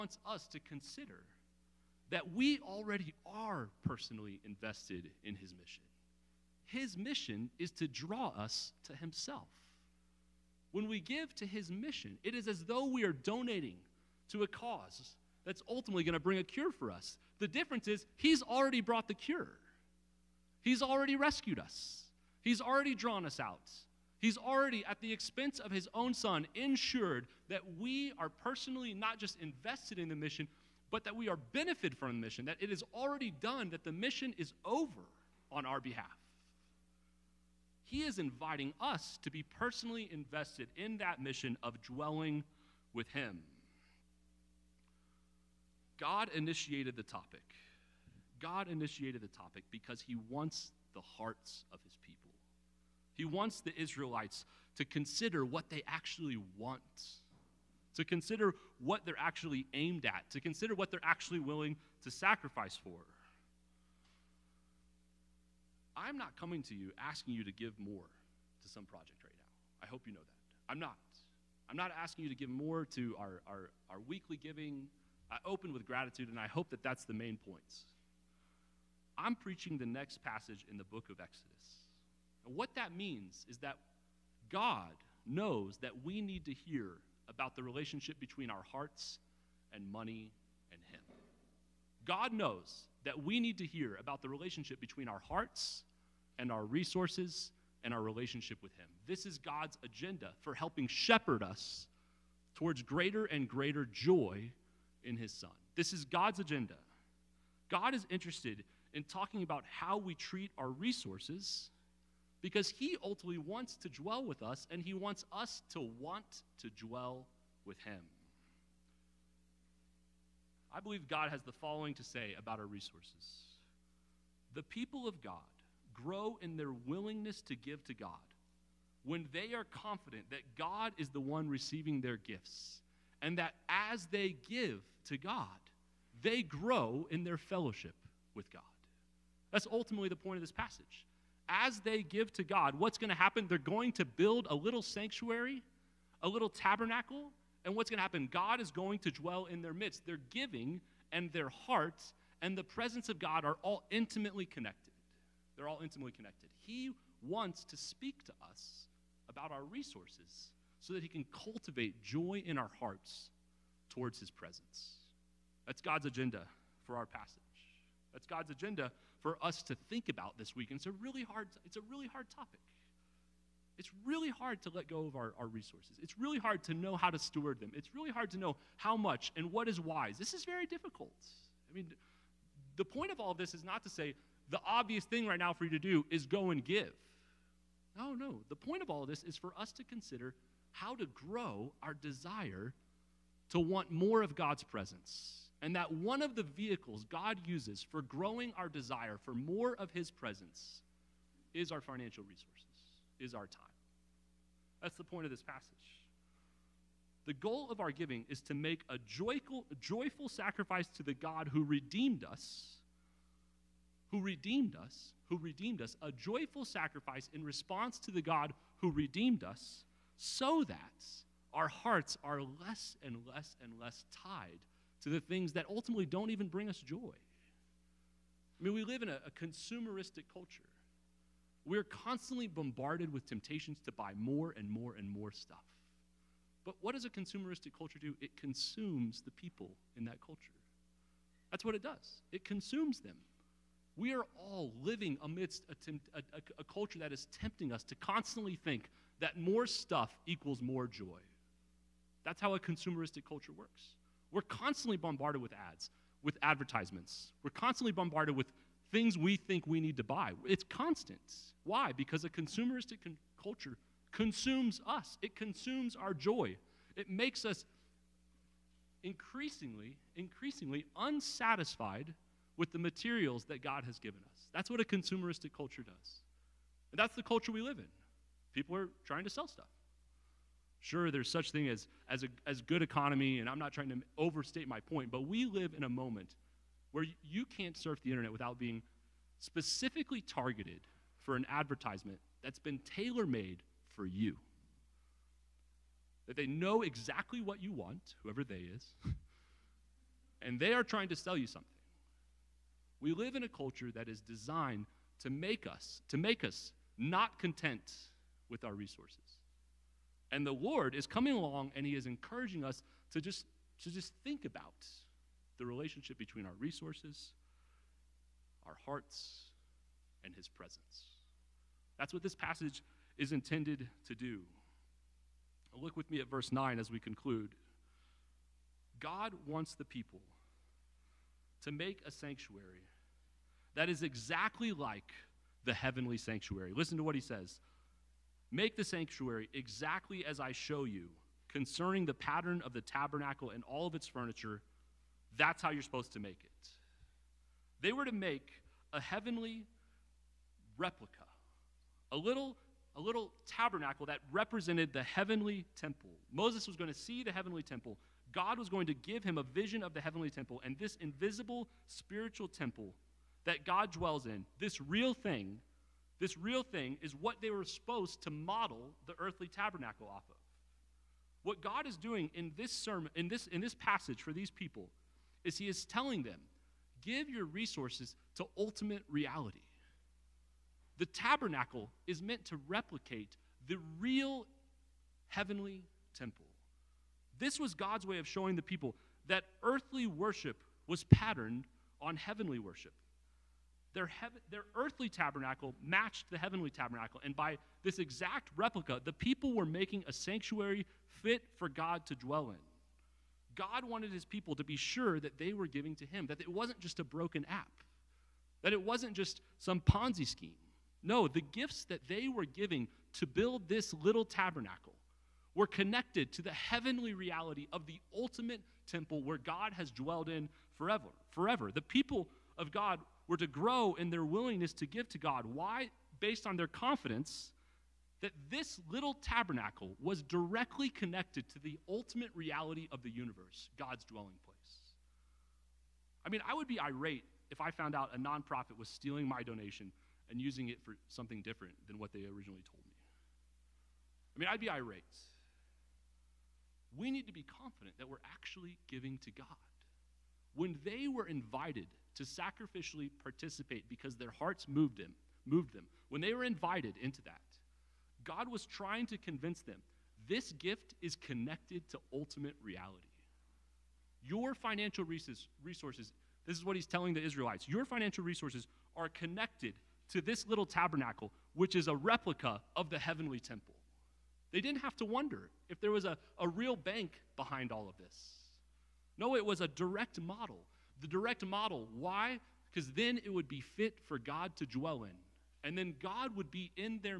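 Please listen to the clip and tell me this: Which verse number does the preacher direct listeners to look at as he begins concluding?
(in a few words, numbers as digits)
9.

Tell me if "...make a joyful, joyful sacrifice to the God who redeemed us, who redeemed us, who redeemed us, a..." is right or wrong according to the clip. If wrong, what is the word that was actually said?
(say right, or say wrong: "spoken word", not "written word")
right.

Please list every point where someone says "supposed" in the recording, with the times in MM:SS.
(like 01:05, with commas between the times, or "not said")
05:45, 06:07.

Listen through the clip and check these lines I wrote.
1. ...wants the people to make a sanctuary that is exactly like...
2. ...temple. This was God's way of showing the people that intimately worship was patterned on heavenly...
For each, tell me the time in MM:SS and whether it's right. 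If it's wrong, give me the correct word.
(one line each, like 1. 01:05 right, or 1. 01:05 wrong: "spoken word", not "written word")
1. 05:29 right
2. 06:26 wrong: "earthly", not "intimately".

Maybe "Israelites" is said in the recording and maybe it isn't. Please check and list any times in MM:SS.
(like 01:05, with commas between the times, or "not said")
00:53, 07:47.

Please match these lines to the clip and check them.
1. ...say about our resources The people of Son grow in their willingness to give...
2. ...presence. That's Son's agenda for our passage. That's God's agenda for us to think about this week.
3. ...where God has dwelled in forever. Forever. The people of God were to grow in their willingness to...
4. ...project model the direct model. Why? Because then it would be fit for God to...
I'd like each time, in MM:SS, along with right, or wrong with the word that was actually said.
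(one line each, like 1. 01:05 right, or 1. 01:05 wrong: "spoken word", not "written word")
1. 02:02 wrong: "God", not "Son"
2. 02:44 wrong: "God", not "Son"
3. 06:59 right
4. 07:59 wrong: "direct", not "project".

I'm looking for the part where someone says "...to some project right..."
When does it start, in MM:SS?
01:08.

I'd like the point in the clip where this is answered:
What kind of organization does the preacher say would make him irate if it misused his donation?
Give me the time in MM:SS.
07:18.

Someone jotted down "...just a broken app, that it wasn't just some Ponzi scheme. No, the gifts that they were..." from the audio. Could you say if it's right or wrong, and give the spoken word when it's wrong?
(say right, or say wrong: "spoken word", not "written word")
right.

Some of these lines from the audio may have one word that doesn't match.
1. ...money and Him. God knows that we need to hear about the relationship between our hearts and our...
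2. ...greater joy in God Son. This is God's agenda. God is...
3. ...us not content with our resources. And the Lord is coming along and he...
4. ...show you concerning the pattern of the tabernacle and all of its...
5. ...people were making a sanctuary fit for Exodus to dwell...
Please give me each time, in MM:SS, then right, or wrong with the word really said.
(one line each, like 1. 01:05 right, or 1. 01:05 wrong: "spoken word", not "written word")
1. 01:29 right
2. 01:43 wrong: "His", not "God"
3. 05:06 right
4. 05:40 right
5. 06:39 wrong: "God", not "Exodus".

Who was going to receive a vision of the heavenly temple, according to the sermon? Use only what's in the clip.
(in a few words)
Moses.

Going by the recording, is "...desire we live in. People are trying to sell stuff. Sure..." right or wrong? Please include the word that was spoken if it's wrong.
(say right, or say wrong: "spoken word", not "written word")
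wrong: "culture", not "desire".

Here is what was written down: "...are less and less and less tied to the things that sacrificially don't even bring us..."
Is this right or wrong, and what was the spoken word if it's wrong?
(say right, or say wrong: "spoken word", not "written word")
wrong: "ultimately", not "sacrificially".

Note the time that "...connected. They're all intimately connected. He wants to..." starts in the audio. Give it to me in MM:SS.
02:34.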